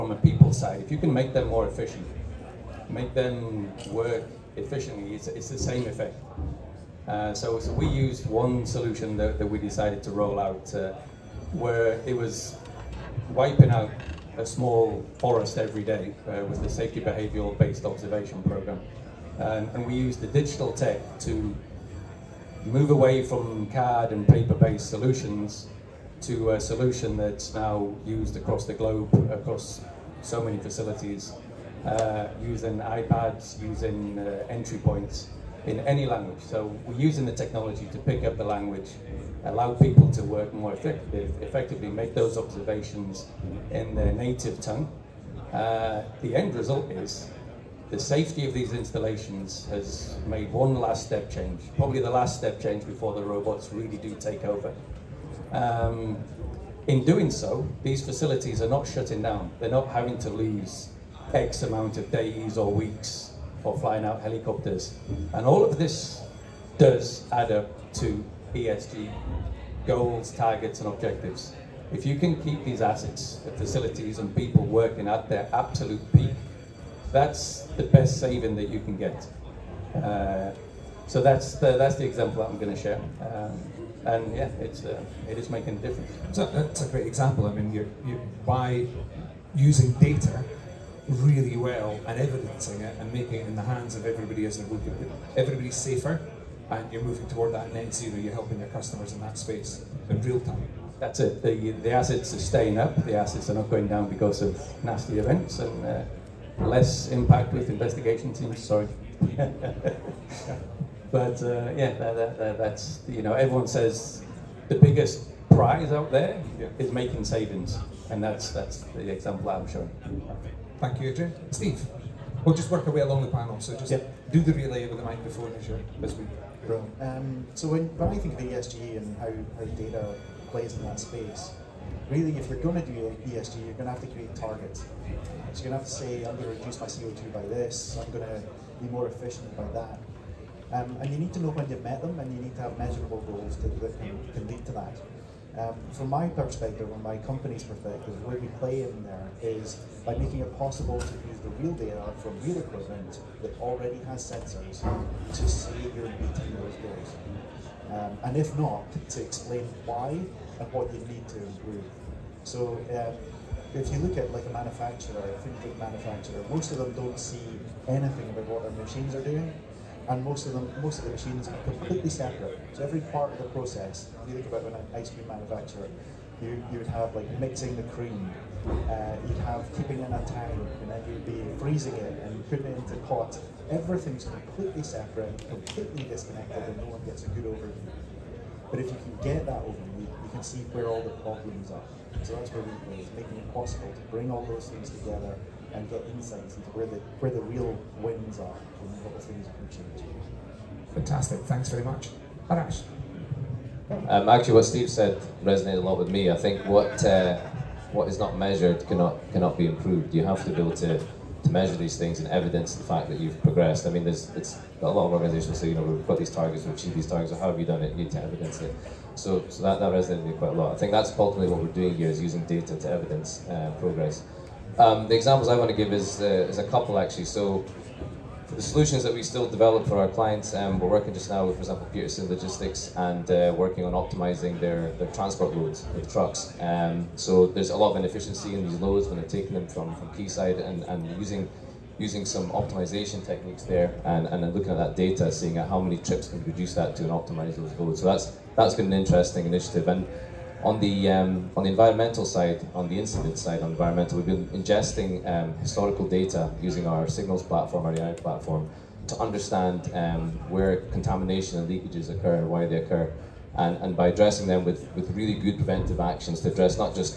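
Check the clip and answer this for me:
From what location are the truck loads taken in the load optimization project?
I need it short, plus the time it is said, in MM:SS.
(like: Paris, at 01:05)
Quayside, at 04:00.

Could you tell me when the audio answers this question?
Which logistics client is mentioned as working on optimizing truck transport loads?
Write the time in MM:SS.
03:51.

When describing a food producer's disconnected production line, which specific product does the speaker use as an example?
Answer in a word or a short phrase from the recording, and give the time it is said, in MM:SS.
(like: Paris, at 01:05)
ice cream, at 02:54.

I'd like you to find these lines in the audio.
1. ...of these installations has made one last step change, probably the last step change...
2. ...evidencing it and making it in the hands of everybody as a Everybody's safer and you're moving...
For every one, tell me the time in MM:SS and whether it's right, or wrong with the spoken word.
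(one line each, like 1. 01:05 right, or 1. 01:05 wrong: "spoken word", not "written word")
1. 00:48 right
2. 01:32 right.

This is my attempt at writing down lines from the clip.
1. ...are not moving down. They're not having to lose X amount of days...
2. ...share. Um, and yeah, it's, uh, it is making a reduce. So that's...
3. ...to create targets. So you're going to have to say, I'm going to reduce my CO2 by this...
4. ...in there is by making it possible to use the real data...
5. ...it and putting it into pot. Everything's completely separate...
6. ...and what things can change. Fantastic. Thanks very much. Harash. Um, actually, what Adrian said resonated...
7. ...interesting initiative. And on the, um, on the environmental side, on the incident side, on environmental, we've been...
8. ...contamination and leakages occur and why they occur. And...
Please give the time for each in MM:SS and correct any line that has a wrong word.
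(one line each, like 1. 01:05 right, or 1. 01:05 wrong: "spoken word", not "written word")
1. 00:58 wrong: "shutting", not "moving"
2. 01:22 wrong: "difference", not "reduce"
3. 02:14 right
4. 02:28 right
5. 03:01 right
6. 03:18 wrong: "Steve", not "Adrian"
7. 04:08 right
8. 04:20 right.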